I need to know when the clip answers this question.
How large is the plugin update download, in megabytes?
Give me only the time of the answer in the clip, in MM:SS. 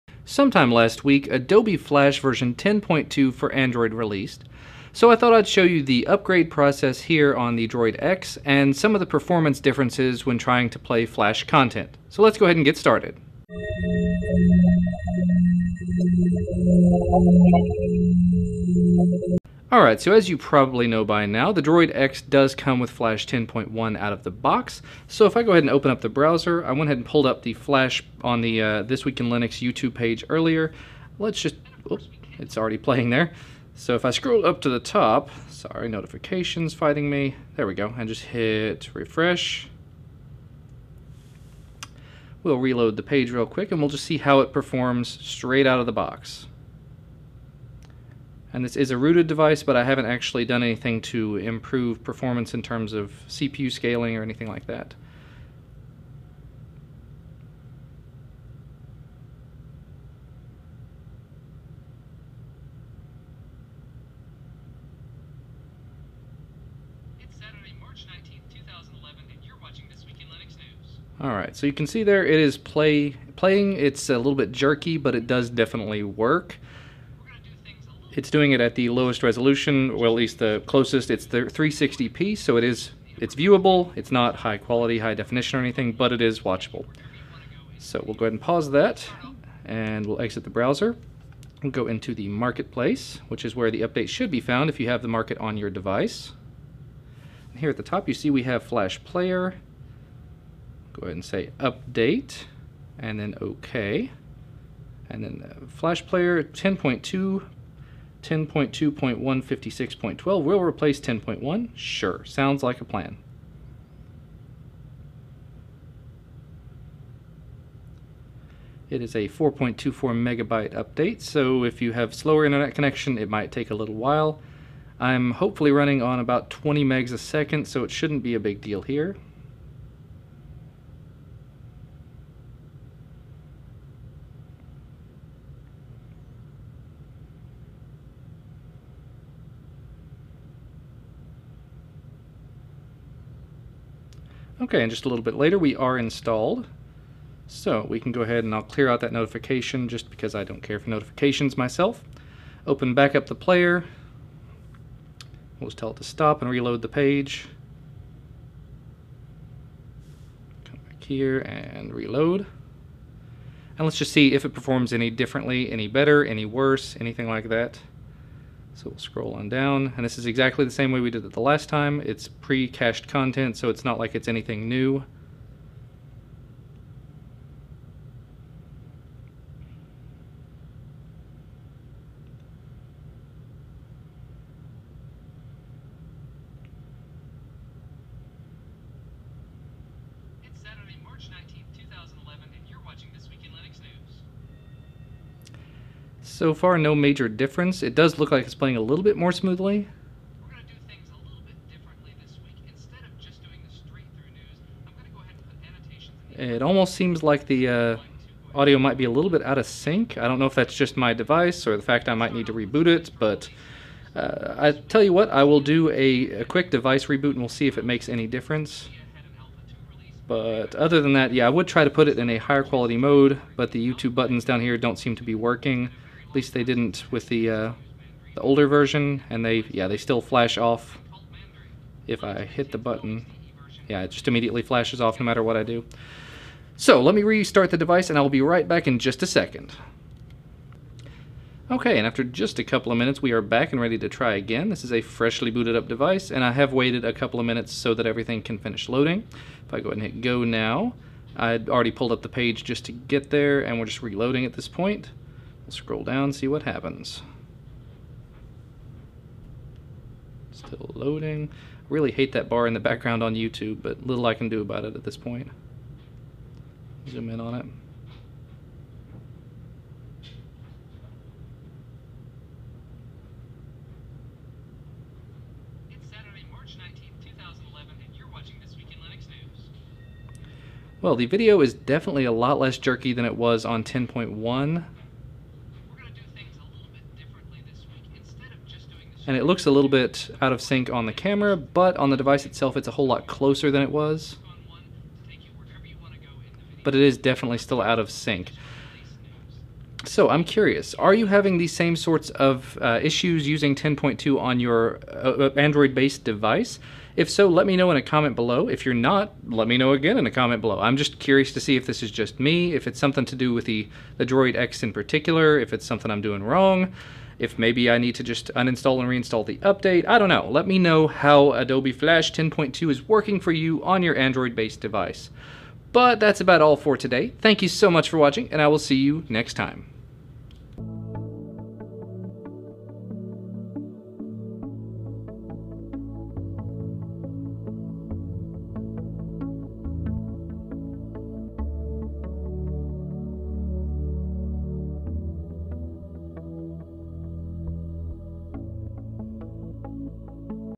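01:59.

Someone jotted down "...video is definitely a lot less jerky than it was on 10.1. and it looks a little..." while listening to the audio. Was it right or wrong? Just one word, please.
right.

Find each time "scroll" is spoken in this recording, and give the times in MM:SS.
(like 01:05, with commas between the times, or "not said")
00:34, 02:48, 04:15.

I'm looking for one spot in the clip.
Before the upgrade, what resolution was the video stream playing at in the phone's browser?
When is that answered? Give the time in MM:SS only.
01:21.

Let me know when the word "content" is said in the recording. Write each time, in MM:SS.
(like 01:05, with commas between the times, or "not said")
00:11, 02:53.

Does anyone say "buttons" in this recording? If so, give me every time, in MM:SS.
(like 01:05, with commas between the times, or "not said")
03:44, 03:52.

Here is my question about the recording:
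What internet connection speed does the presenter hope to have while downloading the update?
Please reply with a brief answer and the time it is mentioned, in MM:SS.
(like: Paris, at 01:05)
20 megs a second, at 02:06.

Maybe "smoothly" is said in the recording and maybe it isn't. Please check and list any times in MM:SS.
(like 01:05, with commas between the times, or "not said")
03:19.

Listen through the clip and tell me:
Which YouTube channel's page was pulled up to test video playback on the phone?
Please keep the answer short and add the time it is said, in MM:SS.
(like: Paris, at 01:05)
This Week in Linux, at 00:28.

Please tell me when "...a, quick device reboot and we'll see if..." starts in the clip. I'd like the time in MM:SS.
03:36.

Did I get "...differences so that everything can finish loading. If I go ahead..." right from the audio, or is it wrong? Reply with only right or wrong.
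wrong.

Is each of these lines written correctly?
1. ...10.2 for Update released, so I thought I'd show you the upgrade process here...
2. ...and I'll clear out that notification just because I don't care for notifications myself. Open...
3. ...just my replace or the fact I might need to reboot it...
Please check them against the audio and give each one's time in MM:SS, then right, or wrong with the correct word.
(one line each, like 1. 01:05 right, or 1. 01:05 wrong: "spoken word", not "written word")
1. 00:02 wrong: "Android", not "Update"
2. 02:28 right
3. 03:30 wrong: "device", not "replace".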